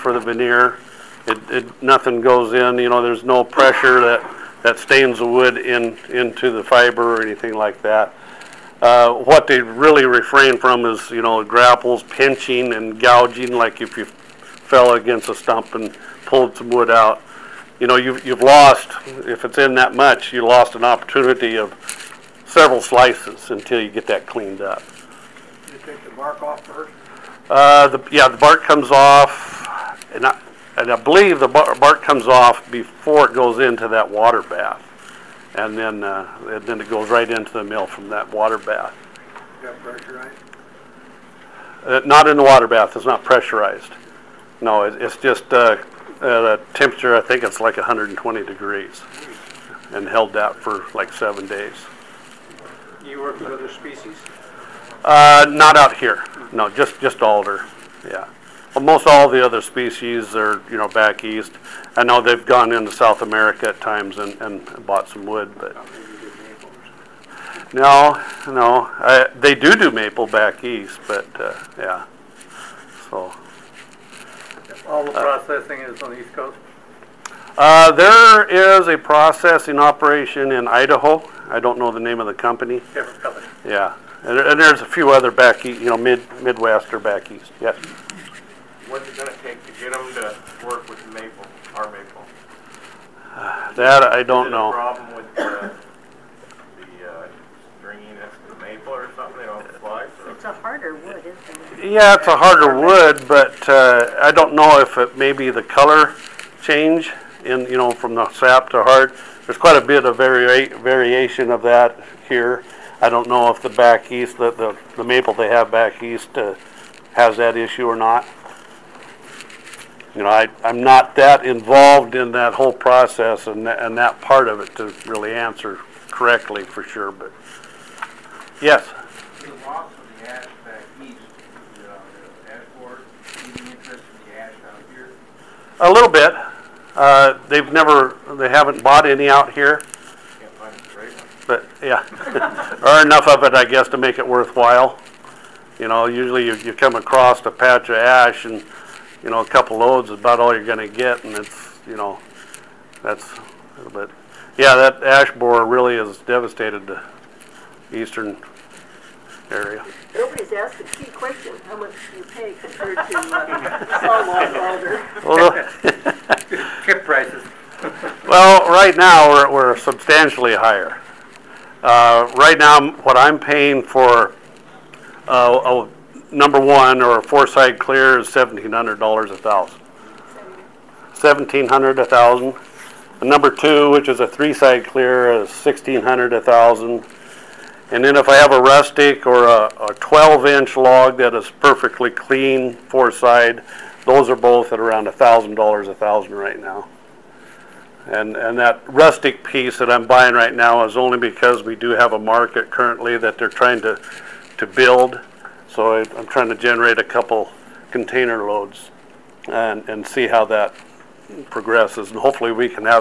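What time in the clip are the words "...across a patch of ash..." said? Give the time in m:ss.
2:26.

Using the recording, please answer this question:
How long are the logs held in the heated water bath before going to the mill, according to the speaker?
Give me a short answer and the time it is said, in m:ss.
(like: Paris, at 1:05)
7 days, at 0:51.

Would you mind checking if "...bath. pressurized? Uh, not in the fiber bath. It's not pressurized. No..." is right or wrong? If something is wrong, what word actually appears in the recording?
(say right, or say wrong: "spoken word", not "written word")
wrong: "water", not "fiber".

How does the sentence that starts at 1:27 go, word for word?
Yes what's it going to take to get them to work with Maple, our Maple?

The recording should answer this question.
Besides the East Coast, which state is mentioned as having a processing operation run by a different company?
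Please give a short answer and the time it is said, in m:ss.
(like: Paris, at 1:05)
Idaho, at 1:20.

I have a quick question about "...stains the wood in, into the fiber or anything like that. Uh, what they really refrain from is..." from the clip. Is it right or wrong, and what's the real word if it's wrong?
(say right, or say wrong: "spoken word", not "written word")
right.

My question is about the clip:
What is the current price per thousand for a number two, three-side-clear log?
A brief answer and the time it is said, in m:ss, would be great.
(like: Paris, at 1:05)
$1,600, at 3:05.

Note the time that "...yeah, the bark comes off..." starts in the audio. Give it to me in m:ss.
0:28.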